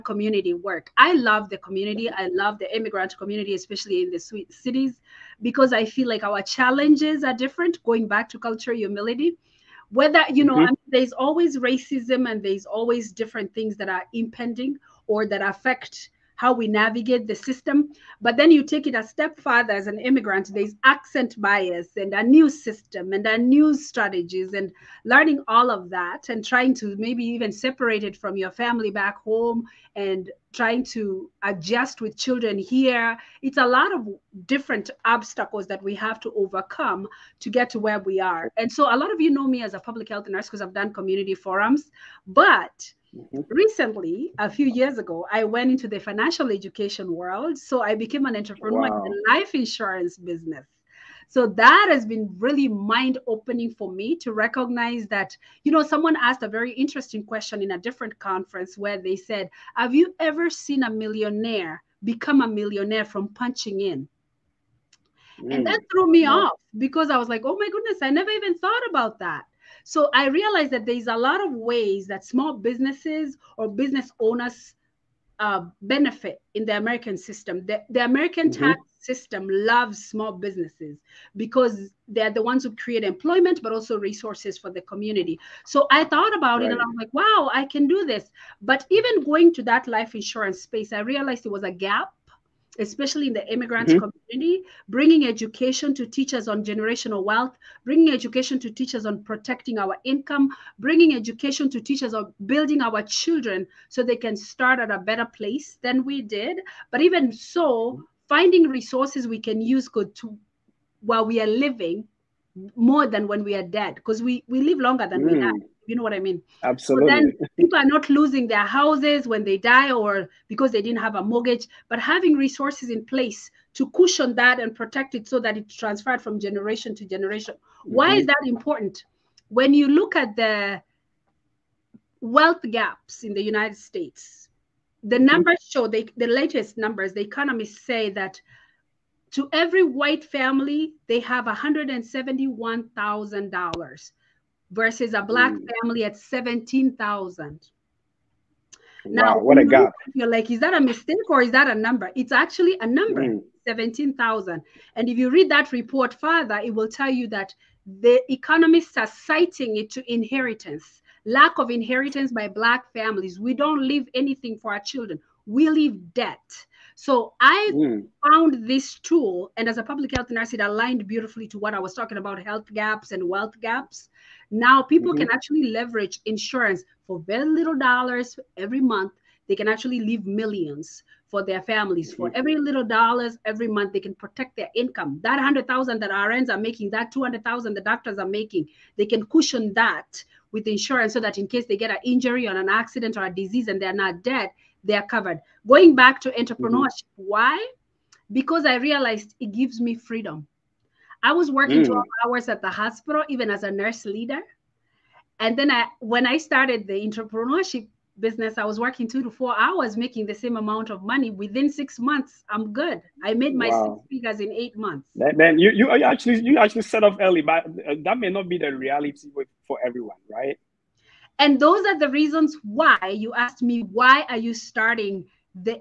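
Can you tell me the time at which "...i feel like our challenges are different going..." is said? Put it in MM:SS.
00:05.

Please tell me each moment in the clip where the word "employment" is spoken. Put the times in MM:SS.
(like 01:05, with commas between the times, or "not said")
01:23.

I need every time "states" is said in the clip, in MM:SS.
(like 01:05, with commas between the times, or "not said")
02:13.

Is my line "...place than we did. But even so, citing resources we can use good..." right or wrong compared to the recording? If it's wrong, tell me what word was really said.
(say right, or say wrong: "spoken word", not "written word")
wrong: "finding", not "citing".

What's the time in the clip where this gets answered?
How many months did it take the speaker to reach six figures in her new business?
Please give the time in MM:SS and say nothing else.
03:34.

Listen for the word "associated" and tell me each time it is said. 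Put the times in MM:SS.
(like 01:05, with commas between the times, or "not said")
not said.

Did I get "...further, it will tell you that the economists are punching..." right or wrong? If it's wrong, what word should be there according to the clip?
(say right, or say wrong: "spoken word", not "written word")
wrong: "citing", not "punching".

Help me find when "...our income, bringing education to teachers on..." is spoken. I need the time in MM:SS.
01:39.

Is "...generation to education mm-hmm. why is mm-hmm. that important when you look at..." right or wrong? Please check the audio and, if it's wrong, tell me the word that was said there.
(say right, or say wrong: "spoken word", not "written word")
wrong: "generation", not "education".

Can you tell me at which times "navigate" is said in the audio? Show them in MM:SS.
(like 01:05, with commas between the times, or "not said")
00:16.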